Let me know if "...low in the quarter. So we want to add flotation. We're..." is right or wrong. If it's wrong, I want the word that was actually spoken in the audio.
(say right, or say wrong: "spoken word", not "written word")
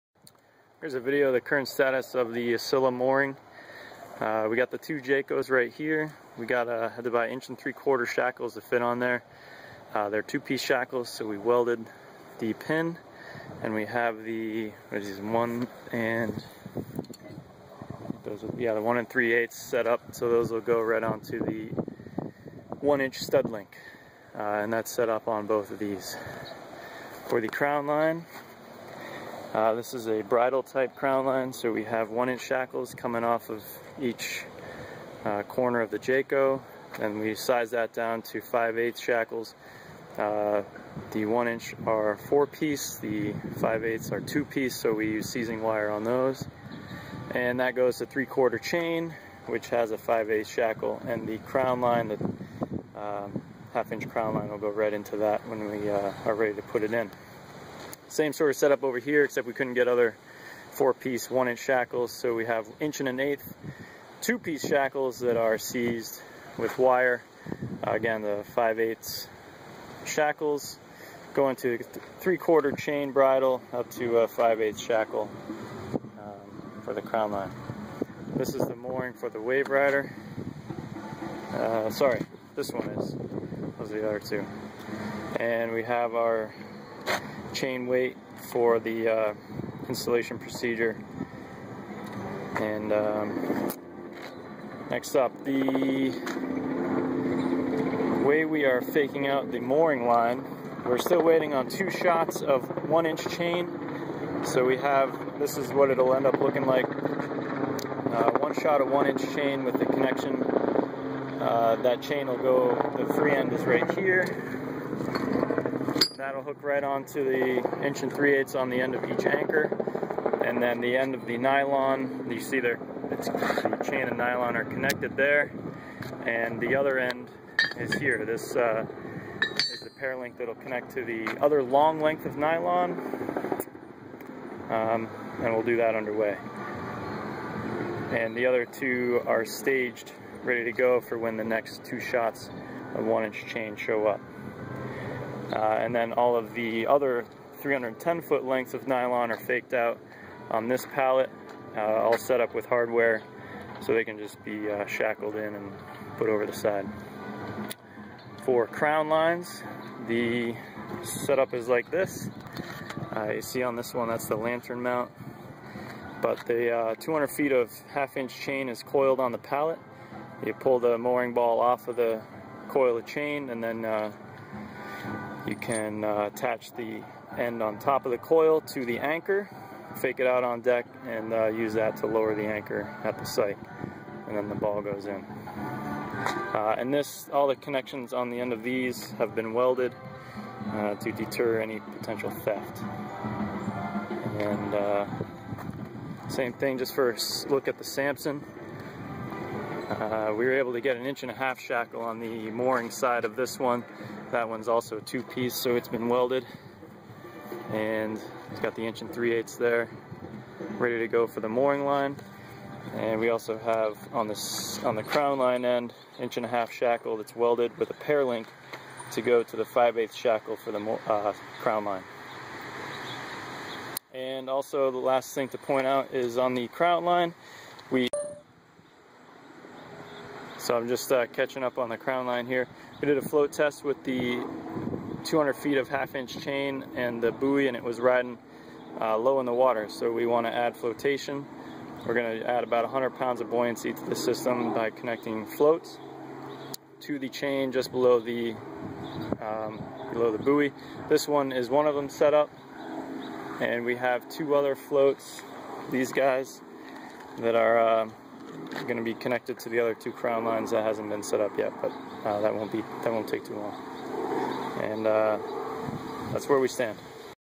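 wrong: "water", not "quarter".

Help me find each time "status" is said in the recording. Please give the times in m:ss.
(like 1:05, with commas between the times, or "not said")
0:01.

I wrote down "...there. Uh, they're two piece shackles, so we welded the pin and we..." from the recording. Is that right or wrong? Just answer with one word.
right.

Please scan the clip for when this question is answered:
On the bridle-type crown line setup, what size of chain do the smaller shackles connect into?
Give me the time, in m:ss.
0:48.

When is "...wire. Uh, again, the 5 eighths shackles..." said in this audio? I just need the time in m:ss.
1:06.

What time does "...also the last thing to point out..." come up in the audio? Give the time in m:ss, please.
3:44.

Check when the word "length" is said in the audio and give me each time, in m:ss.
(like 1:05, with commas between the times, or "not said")
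2:11, 2:28.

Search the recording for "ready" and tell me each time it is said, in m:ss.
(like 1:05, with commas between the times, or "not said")
0:56, 2:20, 3:30.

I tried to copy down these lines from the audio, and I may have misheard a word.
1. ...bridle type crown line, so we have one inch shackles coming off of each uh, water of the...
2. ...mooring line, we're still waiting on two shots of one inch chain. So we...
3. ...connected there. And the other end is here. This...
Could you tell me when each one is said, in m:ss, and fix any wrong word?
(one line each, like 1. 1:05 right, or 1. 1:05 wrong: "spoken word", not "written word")
1. 0:30 wrong: "corner", not "water"
2. 1:39 right
3. 2:04 right.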